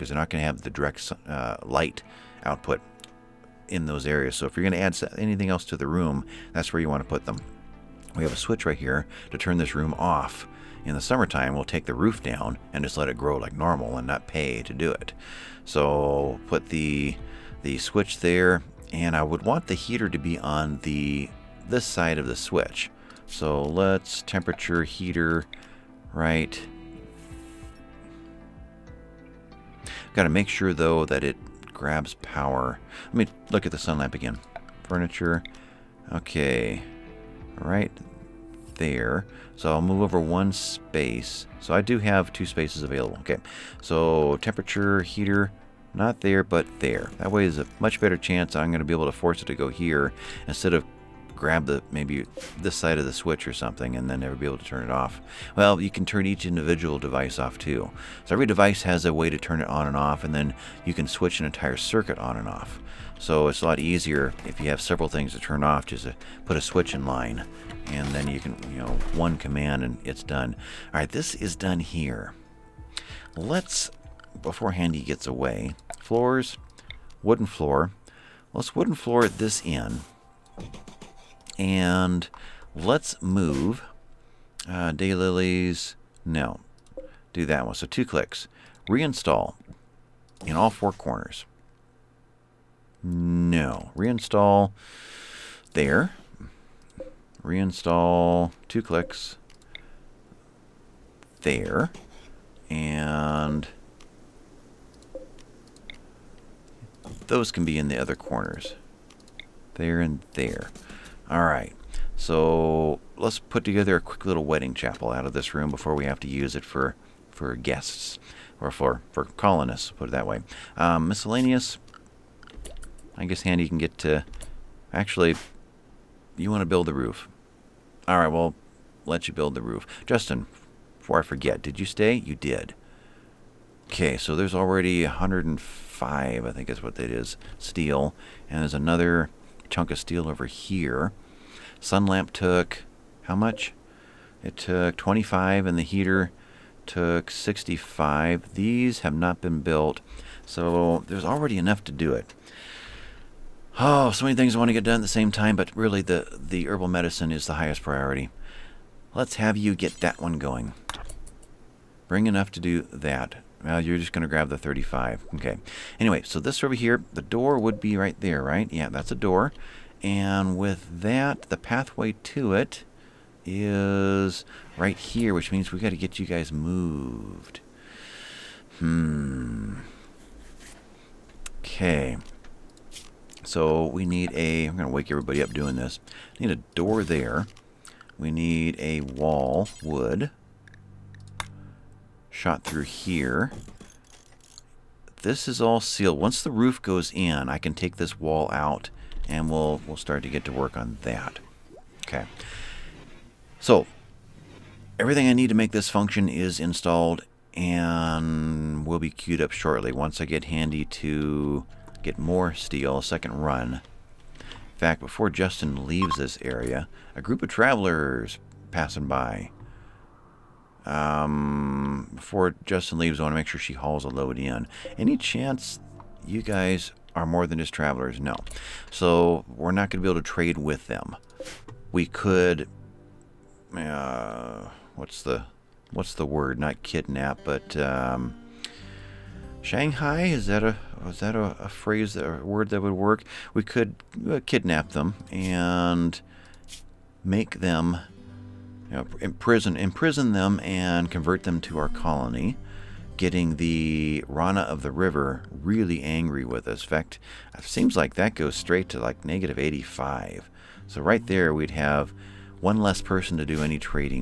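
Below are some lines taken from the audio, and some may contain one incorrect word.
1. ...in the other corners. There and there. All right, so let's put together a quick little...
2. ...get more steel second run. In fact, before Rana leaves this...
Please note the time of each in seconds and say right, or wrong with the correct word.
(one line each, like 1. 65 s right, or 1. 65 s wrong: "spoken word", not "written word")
1. 107 s right
2. 212 s wrong: "Justin", not "Rana".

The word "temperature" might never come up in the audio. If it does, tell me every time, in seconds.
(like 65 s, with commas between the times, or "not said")
24 s, 44 s.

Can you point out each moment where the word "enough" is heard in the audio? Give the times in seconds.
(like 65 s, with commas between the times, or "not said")
151 s, 162 s.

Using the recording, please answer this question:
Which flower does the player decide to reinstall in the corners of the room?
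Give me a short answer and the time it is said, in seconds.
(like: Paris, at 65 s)
Daylilies, at 84 s.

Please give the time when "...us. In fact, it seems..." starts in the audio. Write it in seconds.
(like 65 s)
256 s.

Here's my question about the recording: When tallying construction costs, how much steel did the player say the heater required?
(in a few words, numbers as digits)
65.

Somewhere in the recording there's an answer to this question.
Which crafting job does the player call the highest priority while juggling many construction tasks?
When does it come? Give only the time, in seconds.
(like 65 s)
156 s.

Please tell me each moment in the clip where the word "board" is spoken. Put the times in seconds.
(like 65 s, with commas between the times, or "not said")
not said.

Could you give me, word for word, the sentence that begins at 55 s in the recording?
Well, you can turn each individual device off too.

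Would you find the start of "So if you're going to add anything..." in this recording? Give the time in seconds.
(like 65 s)
4 s.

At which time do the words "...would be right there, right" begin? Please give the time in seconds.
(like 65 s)
167 s.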